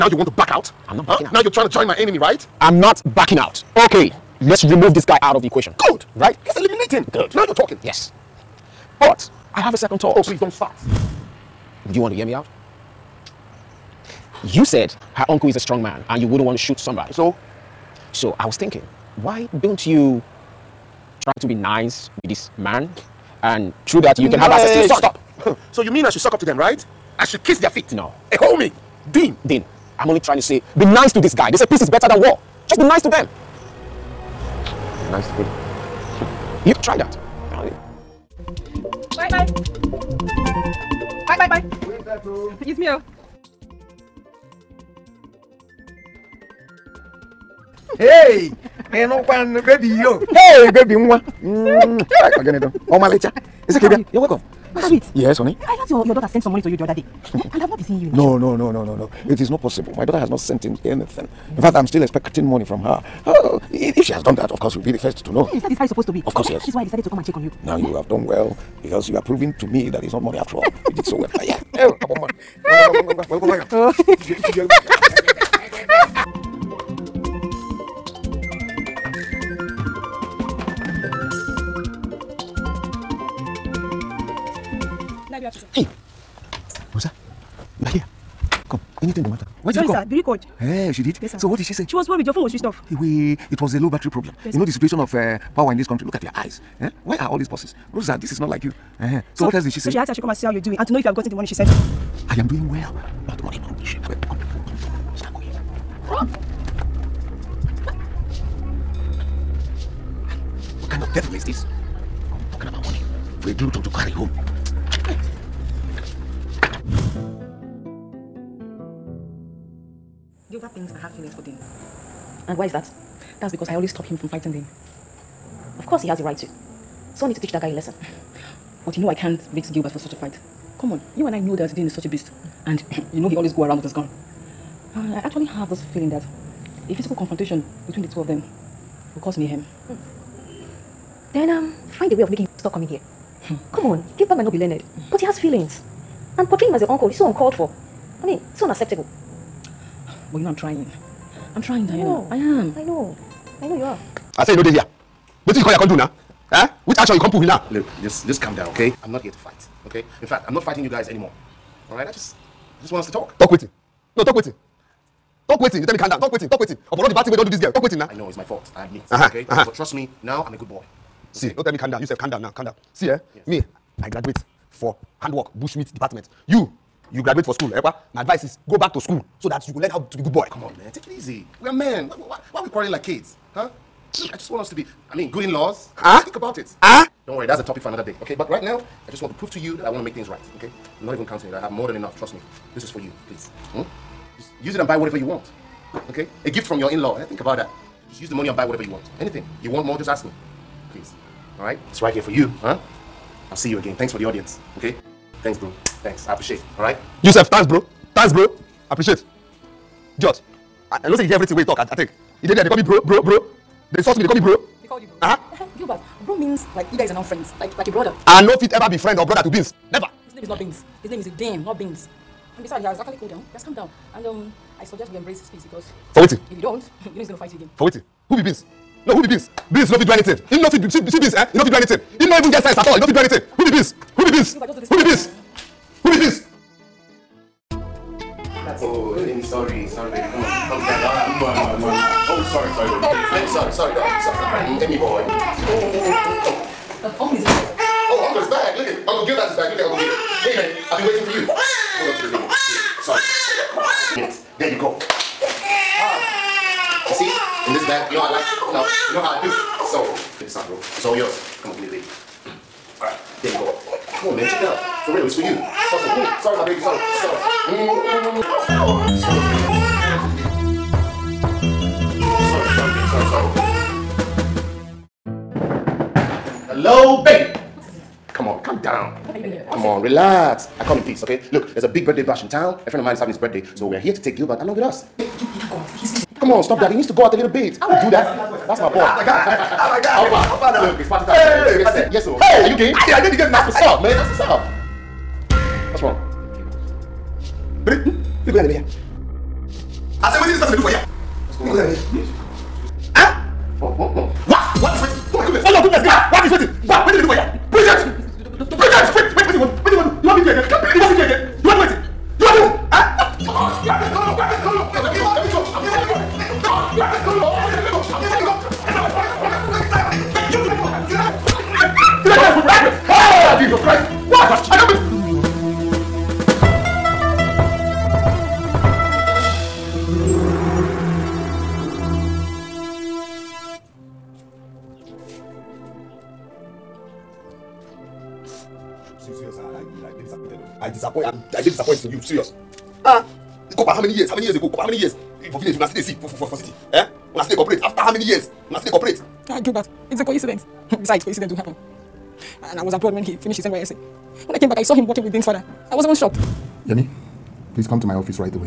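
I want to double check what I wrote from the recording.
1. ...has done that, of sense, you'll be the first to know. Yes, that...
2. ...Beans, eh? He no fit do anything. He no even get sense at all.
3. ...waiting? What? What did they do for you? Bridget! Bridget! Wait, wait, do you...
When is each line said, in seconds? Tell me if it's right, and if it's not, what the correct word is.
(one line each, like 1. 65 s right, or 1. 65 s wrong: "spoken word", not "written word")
1. 64 s wrong: "course", not "sense"
2. 231 s right
3. 306 s right.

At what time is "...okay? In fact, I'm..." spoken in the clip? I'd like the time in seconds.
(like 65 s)
159 s.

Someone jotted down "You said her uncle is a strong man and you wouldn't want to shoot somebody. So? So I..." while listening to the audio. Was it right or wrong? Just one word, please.
right.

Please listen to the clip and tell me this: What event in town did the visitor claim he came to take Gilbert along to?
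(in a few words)
Birthday bash.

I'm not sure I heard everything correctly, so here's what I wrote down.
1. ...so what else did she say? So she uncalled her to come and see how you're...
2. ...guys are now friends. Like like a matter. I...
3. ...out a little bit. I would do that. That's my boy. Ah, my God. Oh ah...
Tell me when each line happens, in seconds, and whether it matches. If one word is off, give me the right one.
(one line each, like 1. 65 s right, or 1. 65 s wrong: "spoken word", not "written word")
1. 99 s wrong: "asked", not "uncalled"
2. 216 s wrong: "brother", not "matter"
3. 287 s right.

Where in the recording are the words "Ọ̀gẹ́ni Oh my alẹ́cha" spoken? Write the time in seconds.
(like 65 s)
52 s.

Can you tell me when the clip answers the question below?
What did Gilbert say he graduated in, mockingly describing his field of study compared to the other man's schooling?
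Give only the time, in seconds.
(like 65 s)
175 s.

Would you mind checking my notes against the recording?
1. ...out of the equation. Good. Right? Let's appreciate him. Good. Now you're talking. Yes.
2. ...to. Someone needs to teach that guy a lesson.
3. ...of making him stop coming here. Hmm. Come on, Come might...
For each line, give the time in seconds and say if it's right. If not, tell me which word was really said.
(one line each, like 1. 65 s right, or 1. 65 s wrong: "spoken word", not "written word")
1. 5 s wrong: "eliminate", not "appreciate"
2. 126 s right
3. 142 s wrong: "Gilbert", not "Come".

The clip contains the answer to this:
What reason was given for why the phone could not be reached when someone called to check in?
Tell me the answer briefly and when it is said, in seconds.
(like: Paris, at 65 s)
Low battery, at 93 s.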